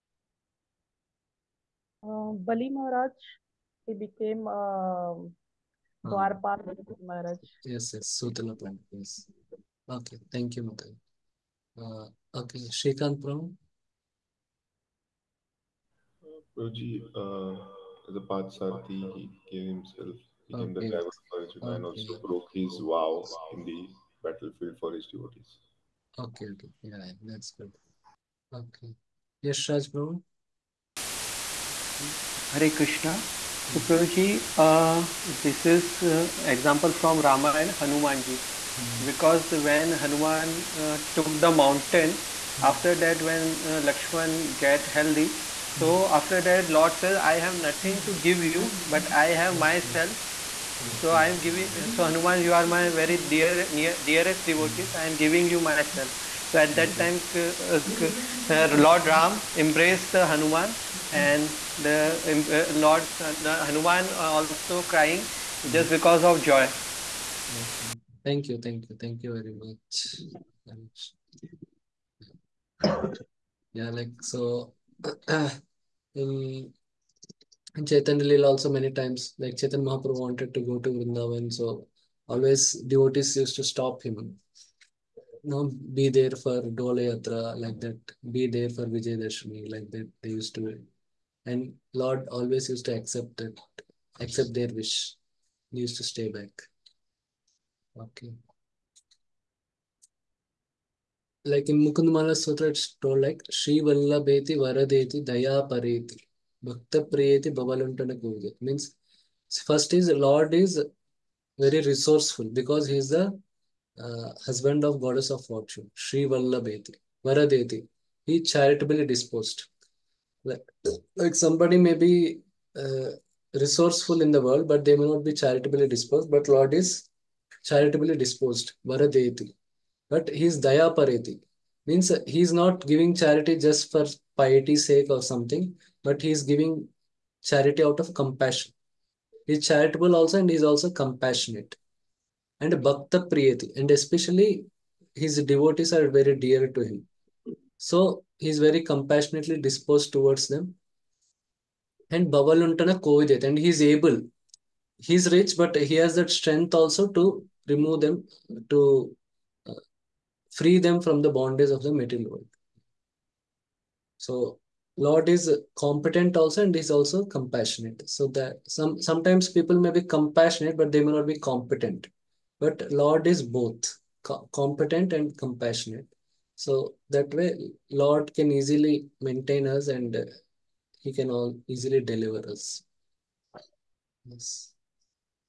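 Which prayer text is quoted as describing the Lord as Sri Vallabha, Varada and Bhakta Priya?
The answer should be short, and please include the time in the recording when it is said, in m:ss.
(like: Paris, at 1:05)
Mukundamala Stotra, at 1:41.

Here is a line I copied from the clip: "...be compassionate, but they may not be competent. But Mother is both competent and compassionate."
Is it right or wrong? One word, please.
wrong.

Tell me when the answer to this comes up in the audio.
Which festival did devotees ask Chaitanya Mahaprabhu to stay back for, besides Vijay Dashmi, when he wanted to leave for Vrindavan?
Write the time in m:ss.
1:26.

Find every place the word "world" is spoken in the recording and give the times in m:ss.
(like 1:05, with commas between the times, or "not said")
2:04, 2:42.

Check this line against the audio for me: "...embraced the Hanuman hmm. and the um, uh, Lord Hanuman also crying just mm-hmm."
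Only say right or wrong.
right.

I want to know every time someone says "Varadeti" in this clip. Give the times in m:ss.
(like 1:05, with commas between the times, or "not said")
1:44, 1:57, 2:08.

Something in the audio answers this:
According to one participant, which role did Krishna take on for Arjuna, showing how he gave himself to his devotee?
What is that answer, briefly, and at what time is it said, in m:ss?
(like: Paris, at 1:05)
Driver, at 0:20.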